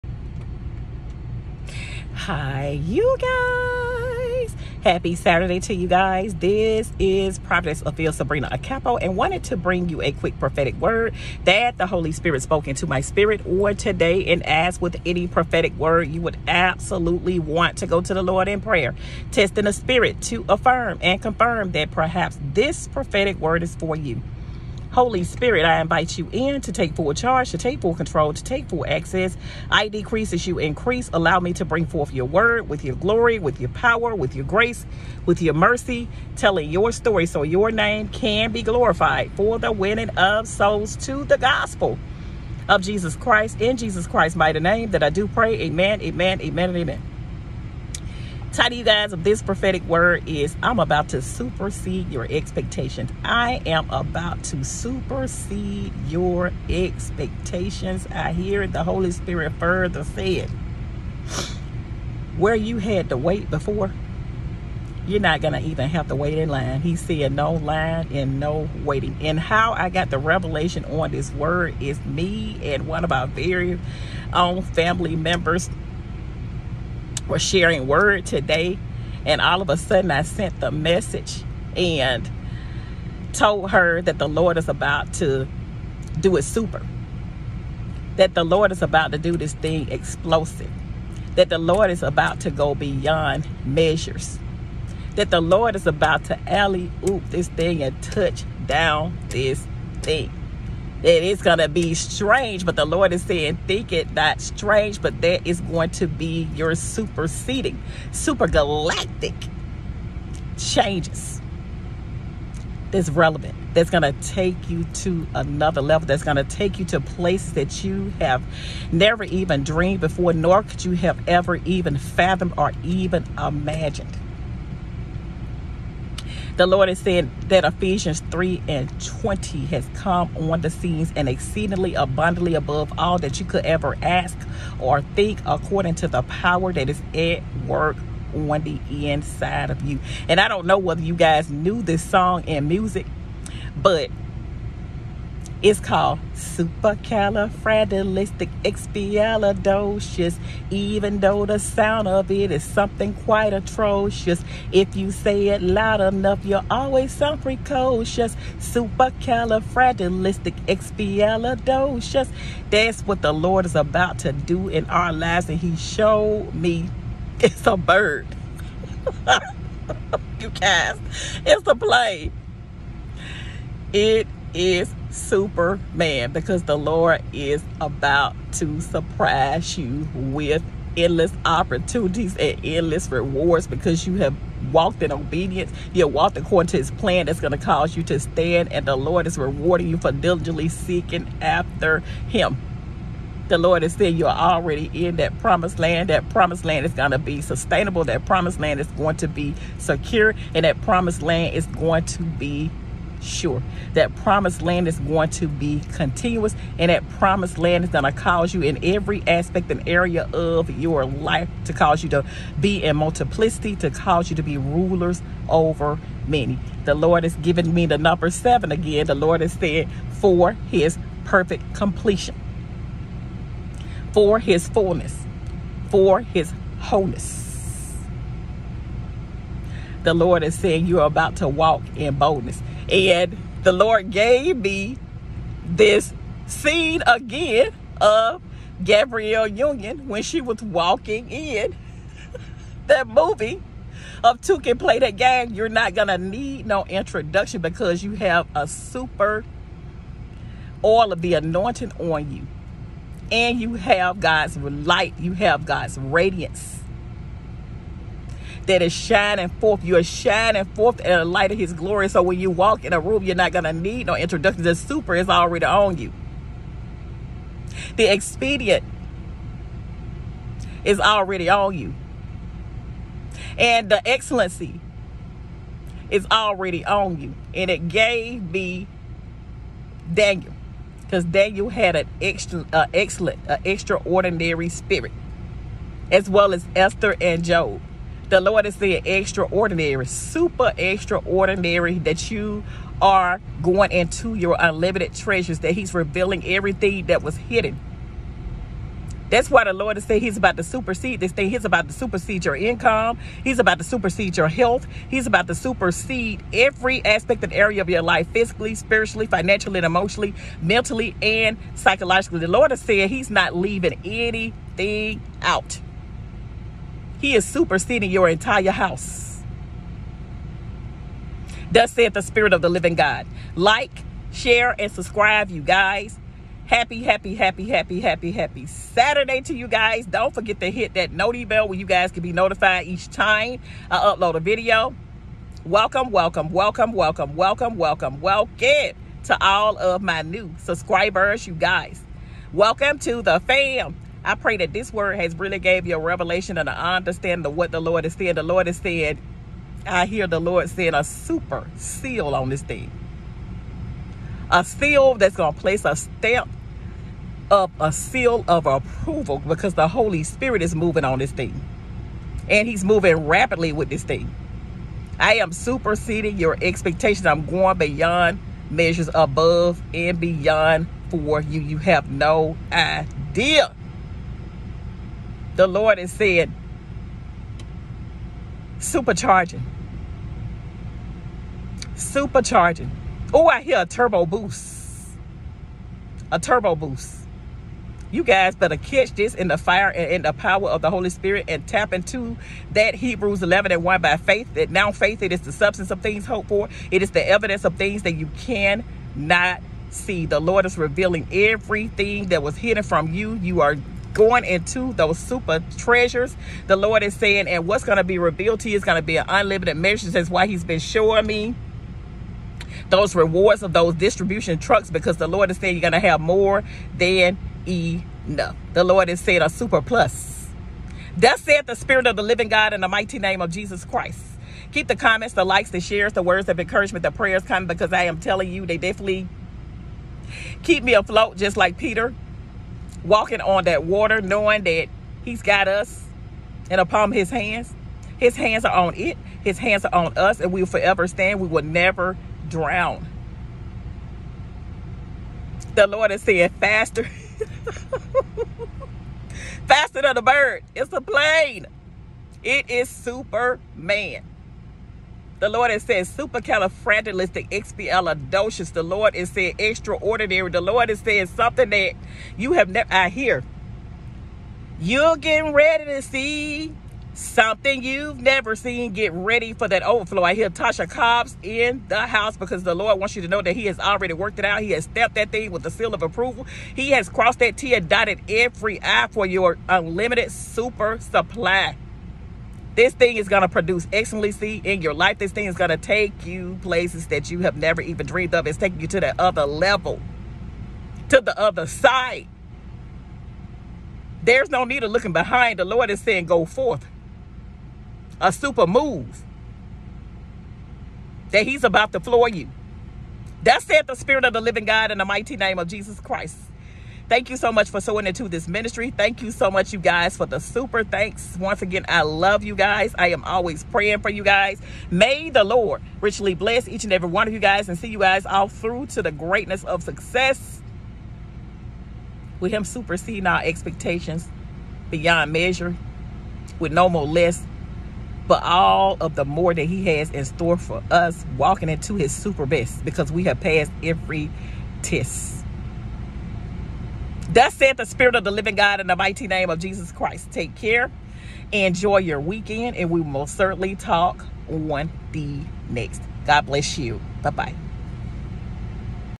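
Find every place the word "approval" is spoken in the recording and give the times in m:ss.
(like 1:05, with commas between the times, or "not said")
5:58, 7:56.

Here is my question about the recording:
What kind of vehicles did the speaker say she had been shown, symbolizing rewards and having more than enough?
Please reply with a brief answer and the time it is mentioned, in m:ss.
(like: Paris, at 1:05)
Distribution trucks, at 6:53.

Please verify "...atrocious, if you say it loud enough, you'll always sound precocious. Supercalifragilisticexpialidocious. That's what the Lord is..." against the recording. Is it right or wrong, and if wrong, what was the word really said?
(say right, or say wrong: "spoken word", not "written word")
right.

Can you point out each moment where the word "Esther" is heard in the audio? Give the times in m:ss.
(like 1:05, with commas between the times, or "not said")
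4:46.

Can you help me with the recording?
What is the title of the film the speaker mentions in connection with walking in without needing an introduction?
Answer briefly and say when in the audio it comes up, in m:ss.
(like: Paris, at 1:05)
Two Can Play That Game, at 4:04.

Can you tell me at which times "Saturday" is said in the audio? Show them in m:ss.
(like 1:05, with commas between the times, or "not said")
0:05, 5:28.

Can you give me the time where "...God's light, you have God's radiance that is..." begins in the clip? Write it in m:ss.
4:14.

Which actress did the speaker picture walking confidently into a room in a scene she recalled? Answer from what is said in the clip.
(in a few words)
Gabrielle Union.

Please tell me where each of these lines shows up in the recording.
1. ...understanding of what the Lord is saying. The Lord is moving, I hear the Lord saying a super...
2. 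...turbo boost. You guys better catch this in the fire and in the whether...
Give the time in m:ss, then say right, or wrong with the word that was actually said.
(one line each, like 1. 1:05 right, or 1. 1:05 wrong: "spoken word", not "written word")
1. 5:46 wrong: "saying", not "moving"
2. 6:26 wrong: "power", not "whether".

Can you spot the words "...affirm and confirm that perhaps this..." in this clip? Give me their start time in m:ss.
0:20.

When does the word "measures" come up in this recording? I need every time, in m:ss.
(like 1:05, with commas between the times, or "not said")
1:33, 6:08, 6:49, 8:45.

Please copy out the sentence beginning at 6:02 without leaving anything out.
And he's moving rapidly with this thing.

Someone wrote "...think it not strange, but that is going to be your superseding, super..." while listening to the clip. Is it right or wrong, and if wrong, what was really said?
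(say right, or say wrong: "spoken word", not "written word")
right.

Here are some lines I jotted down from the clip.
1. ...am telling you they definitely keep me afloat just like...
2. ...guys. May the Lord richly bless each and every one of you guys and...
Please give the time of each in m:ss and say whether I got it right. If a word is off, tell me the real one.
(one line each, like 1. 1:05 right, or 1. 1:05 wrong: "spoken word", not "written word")
1. 7:08 right
2. 8:34 right.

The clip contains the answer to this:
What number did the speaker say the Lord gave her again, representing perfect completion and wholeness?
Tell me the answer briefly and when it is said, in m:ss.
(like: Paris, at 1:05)
7, at 3:38.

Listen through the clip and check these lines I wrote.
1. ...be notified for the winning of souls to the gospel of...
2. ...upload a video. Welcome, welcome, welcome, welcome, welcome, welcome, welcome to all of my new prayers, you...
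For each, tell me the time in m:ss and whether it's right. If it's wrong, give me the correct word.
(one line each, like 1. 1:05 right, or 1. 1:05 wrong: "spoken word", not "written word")
1. 0:38 wrong: "glorified", not "notified"
2. 5:33 wrong: "subscribers", not "prayers".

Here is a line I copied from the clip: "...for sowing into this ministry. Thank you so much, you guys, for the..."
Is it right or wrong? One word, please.
right.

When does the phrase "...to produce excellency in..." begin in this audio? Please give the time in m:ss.
8:03.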